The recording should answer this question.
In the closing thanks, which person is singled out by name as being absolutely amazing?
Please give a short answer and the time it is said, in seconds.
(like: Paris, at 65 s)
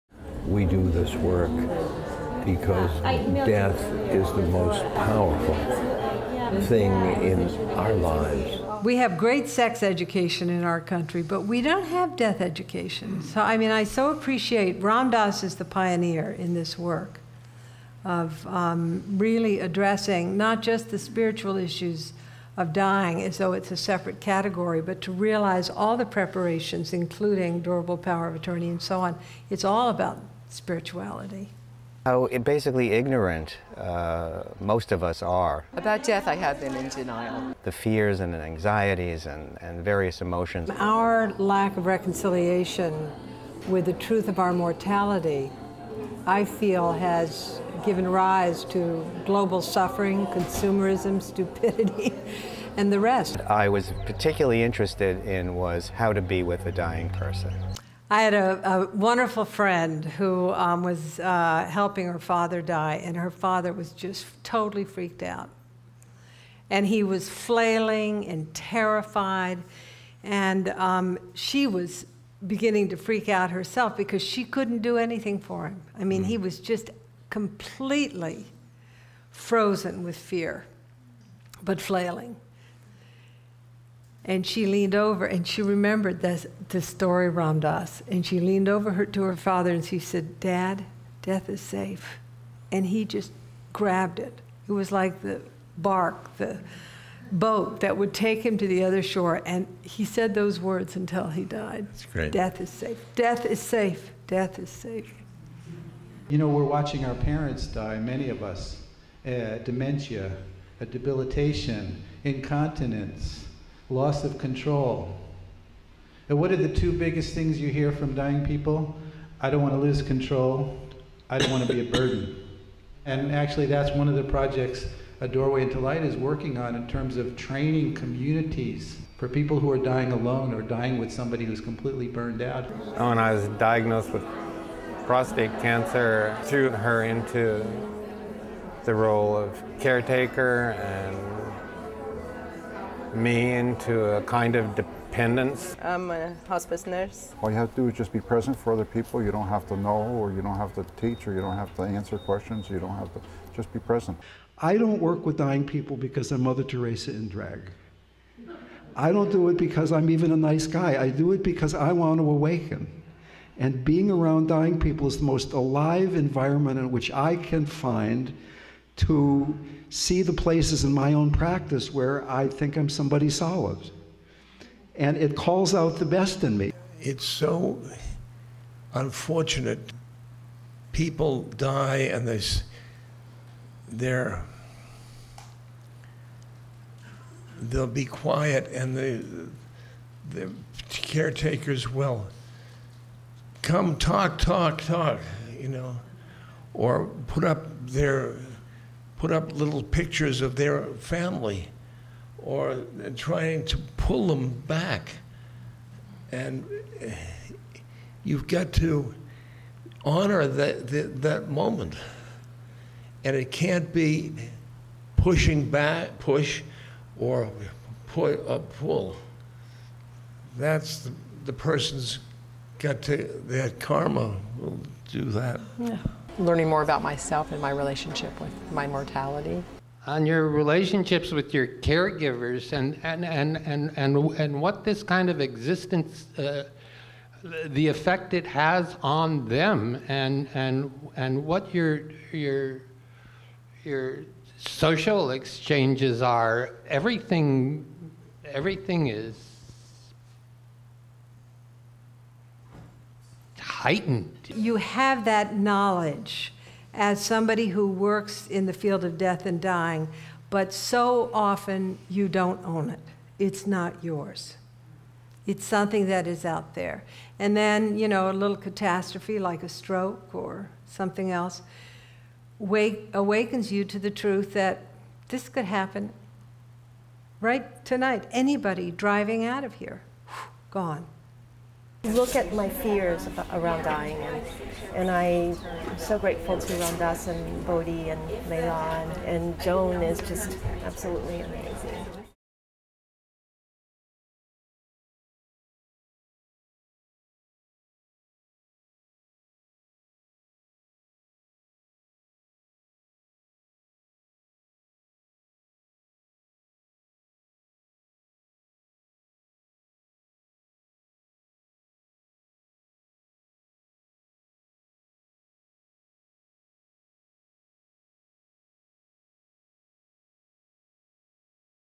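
Joan, at 289 s.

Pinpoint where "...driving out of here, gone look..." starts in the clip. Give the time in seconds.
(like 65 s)
278 s.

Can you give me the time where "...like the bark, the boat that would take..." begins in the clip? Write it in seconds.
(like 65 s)
94 s.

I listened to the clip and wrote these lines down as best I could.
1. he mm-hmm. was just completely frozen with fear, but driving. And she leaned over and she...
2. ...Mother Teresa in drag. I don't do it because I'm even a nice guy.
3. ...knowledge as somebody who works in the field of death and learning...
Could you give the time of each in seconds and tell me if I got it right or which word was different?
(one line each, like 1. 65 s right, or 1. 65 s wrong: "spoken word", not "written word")
1. 76 s wrong: "flailing", not "driving"
2. 156 s right
3. 255 s wrong: "dying", not "learning".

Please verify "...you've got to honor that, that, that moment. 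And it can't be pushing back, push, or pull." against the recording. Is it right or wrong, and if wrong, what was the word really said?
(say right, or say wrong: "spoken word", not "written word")
right.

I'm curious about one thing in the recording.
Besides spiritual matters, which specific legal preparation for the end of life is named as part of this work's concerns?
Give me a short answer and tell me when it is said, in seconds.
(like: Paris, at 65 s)
durable power of attorney, at 27 s.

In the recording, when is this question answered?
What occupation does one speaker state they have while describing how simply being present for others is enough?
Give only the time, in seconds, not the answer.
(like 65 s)
146 s.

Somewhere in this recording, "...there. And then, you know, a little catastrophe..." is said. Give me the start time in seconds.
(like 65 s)
266 s.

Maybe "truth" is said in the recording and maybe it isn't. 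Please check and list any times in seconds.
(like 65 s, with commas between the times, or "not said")
43 s, 274 s.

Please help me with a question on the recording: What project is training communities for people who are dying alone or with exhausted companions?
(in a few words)
A Doorway into Light.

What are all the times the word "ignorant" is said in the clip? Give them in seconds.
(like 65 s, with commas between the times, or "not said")
32 s.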